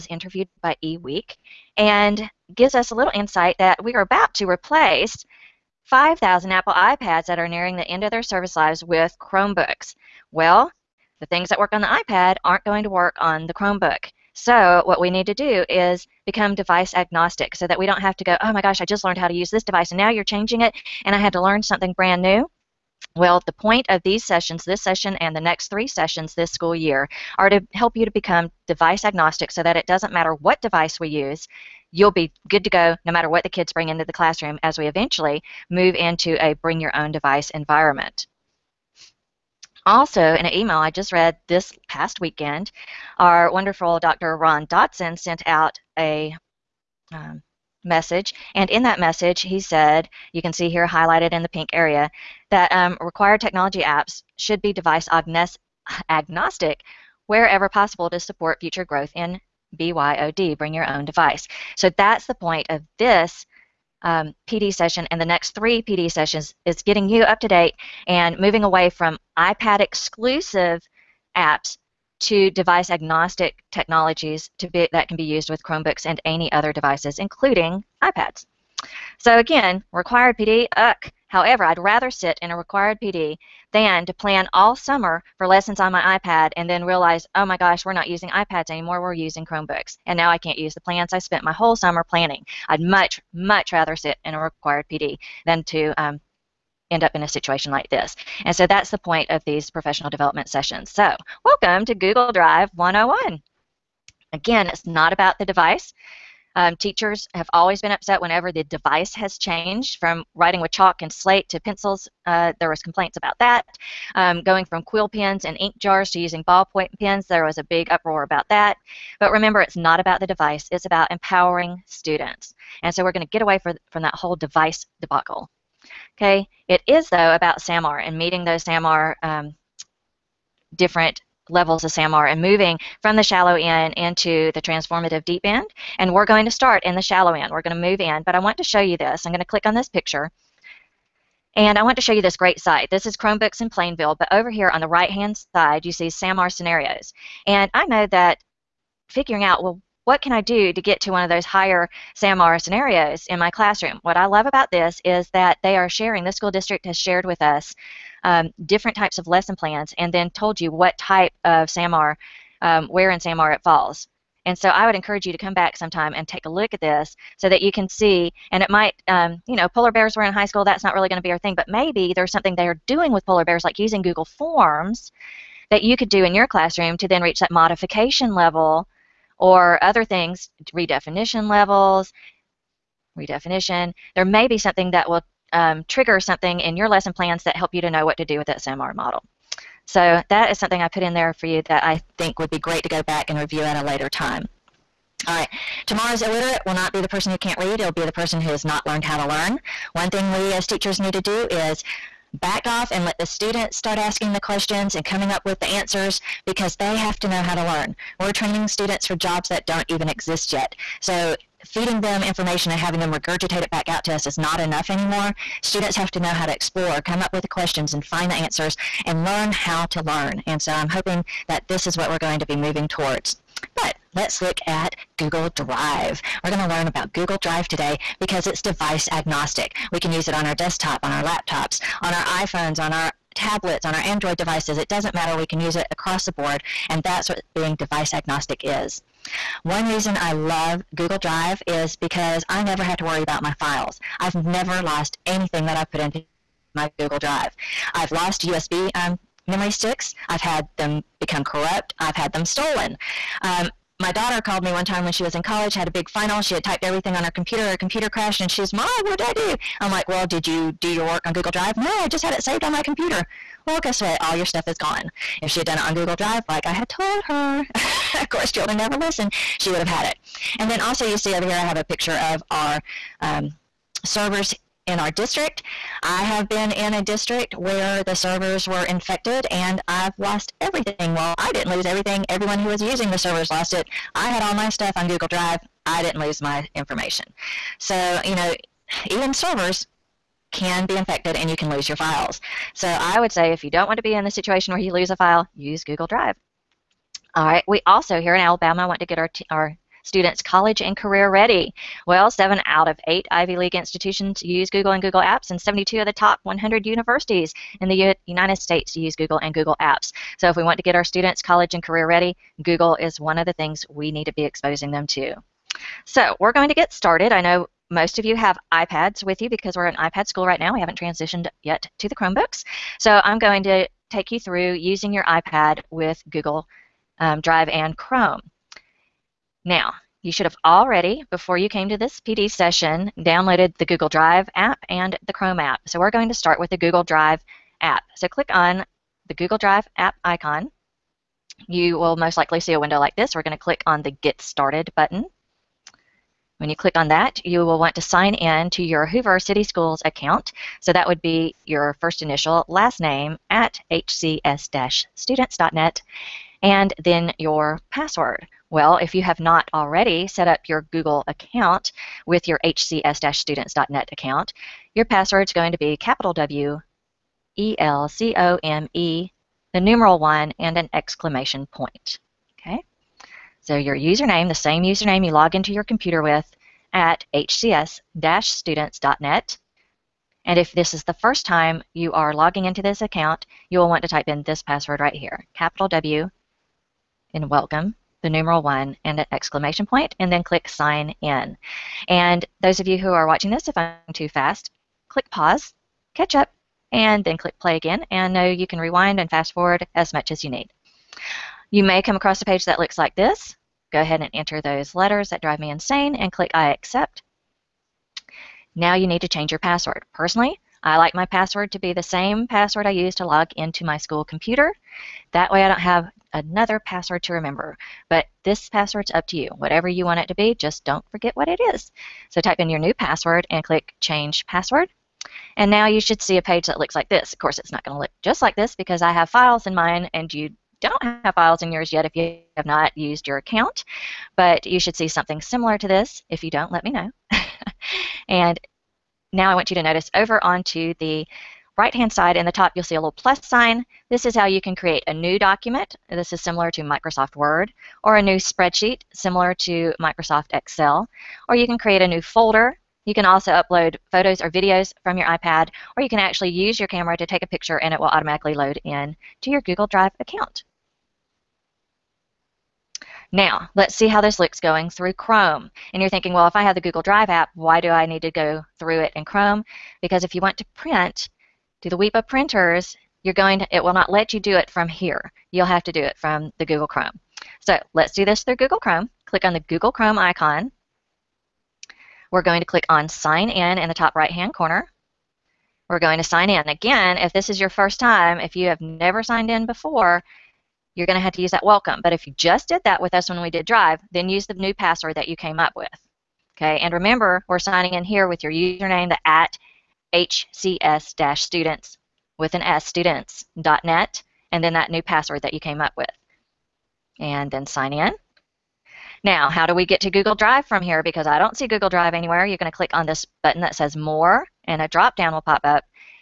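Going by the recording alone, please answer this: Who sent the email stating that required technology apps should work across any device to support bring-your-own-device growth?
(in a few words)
Dr. Ron Dotson.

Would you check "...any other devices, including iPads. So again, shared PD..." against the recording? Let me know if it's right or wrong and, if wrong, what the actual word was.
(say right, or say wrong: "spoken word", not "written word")
wrong: "required", not "shared".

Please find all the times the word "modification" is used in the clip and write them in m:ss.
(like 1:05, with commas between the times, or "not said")
2:57.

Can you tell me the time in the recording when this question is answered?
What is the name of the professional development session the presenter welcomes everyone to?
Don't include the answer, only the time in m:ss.
1:41.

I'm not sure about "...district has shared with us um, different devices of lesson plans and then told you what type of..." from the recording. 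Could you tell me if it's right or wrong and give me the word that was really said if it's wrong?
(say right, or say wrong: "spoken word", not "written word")
wrong: "types", not "devices".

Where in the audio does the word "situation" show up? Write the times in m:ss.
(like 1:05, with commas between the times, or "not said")
1:37, 4:54.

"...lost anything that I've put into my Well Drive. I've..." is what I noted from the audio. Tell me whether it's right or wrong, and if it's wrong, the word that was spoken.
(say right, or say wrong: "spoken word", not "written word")
wrong: "Google", not "Well".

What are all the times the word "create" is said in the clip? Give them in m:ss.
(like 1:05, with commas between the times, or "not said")
7:24, 7:31.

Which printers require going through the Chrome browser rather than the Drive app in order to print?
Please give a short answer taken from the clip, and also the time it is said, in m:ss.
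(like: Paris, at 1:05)
WEPA printers, at 7:51.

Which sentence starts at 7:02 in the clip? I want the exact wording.
So type in your new password and click Change Password.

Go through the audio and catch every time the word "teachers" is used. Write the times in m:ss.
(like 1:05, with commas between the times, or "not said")
1:46, 3:20.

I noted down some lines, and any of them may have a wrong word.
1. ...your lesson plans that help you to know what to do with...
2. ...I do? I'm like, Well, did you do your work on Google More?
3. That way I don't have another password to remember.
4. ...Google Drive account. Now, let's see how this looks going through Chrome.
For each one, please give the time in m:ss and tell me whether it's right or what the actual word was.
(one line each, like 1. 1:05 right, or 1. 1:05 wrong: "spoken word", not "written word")
1. 3:06 right
2. 4:19 wrong: "Drive", not "More"
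3. 6:55 right
4. 7:39 right.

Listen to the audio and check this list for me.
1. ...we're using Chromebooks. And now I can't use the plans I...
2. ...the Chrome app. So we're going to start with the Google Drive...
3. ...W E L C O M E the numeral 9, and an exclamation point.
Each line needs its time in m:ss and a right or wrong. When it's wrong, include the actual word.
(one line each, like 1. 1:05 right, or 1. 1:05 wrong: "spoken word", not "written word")
1. 1:29 right
2. 5:35 right
3. 6:06 wrong: "1", not "9".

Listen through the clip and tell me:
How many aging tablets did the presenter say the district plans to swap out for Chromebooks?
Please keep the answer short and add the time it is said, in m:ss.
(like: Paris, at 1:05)
5,000, at 0:05.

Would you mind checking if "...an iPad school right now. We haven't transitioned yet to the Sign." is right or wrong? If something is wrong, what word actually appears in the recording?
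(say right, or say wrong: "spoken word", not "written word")
wrong: "Chromebooks", not "Sign".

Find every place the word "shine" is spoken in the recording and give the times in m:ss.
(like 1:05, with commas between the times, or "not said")
not said.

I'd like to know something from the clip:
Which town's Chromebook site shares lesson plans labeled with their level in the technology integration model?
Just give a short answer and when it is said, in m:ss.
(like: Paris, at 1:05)
Plainville, at 2:23.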